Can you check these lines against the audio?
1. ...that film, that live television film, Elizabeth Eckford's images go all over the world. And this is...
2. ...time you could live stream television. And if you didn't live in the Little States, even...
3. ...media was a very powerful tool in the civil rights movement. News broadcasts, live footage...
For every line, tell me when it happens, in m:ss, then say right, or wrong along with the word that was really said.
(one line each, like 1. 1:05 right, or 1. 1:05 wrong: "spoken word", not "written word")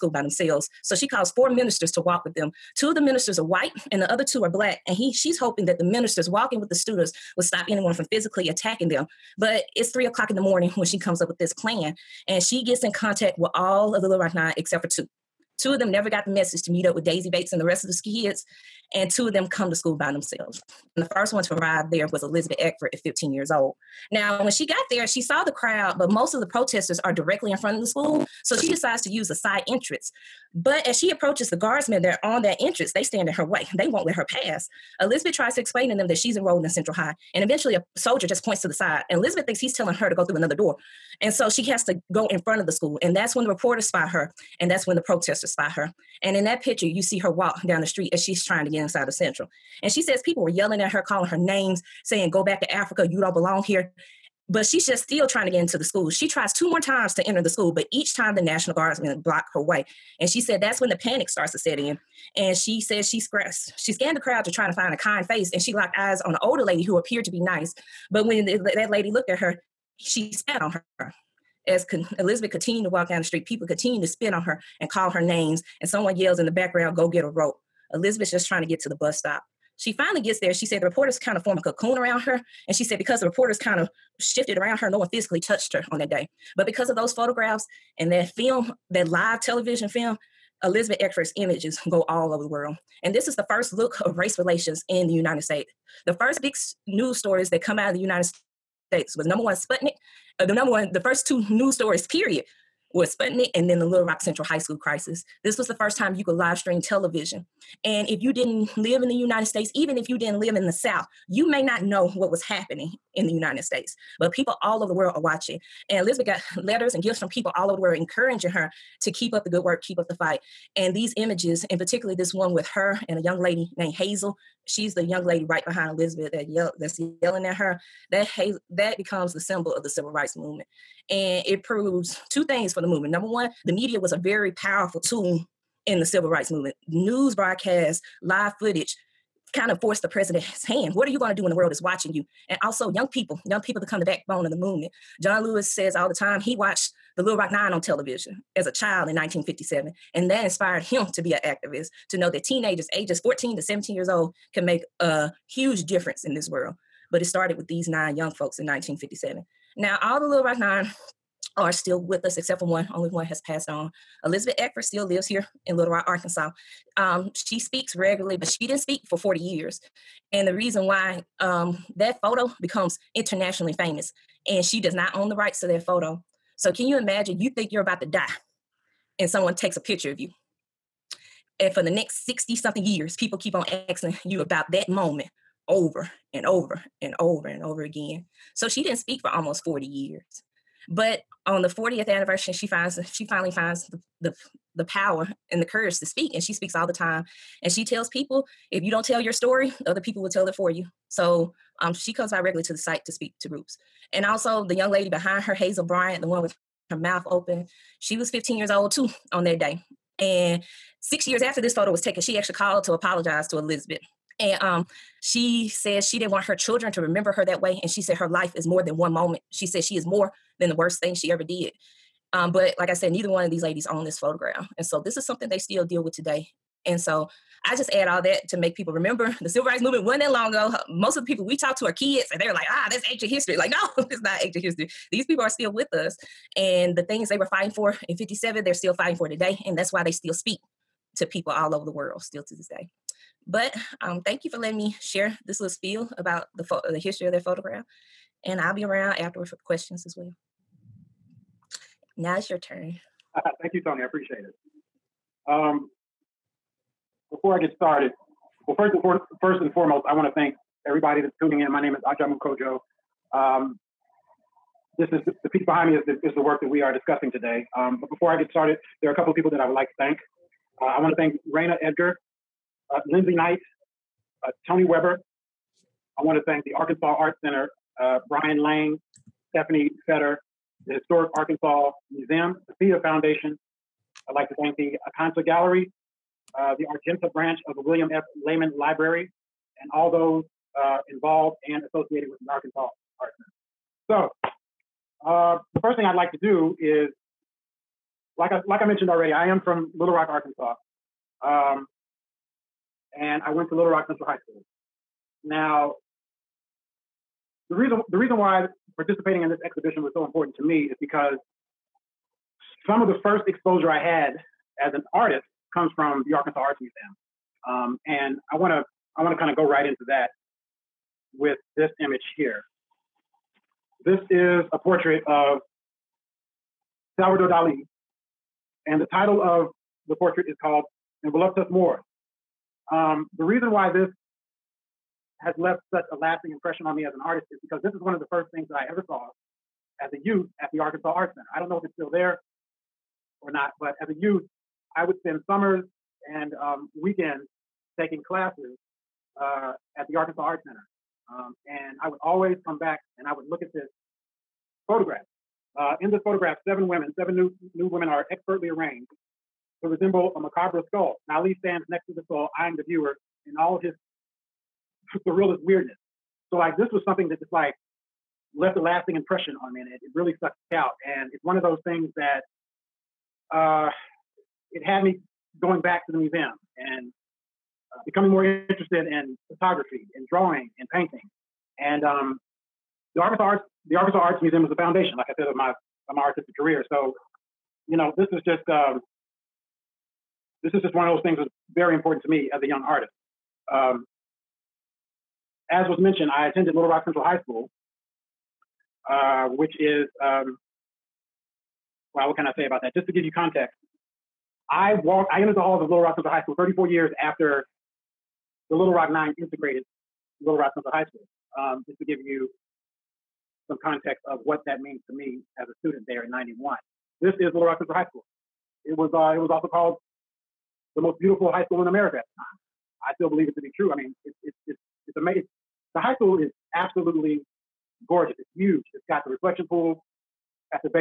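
1. 1:28 right
2. 1:45 wrong: "United", not "Little"
3. 2:13 right.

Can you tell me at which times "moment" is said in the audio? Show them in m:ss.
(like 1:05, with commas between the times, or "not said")
3:04, 3:39.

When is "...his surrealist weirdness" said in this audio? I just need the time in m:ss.
6:03.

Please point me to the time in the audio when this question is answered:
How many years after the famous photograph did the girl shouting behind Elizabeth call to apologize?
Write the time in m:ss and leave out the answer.
3:31.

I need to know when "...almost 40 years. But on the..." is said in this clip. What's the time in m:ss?
3:09.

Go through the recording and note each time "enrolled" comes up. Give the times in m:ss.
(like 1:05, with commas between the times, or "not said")
0:36.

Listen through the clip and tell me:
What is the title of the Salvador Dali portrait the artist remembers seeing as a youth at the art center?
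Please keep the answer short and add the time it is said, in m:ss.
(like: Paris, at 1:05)
In Voluptas Mors, at 5:31.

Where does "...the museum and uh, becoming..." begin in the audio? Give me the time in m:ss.
6:16.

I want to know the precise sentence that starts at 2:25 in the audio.
John Lewis says all the time he watched the Little Rock Nine on television as a child in 1957.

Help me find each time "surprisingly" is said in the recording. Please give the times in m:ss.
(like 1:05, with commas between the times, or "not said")
not said.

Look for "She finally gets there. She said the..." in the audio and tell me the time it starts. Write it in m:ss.
1:19.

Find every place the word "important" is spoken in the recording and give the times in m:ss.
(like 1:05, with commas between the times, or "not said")
5:10, 6:31.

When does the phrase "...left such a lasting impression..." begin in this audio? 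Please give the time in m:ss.
5:35.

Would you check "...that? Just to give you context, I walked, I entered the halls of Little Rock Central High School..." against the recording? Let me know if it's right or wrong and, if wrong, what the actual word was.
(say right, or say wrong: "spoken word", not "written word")
right.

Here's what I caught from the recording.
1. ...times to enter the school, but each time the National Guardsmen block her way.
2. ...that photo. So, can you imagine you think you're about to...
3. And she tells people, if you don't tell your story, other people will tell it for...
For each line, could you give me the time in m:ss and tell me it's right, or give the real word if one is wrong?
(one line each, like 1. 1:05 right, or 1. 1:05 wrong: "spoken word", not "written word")
1. 0:56 right
2. 2:55 right
3. 3:17 right.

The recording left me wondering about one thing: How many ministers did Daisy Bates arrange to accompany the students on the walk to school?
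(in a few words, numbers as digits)
4.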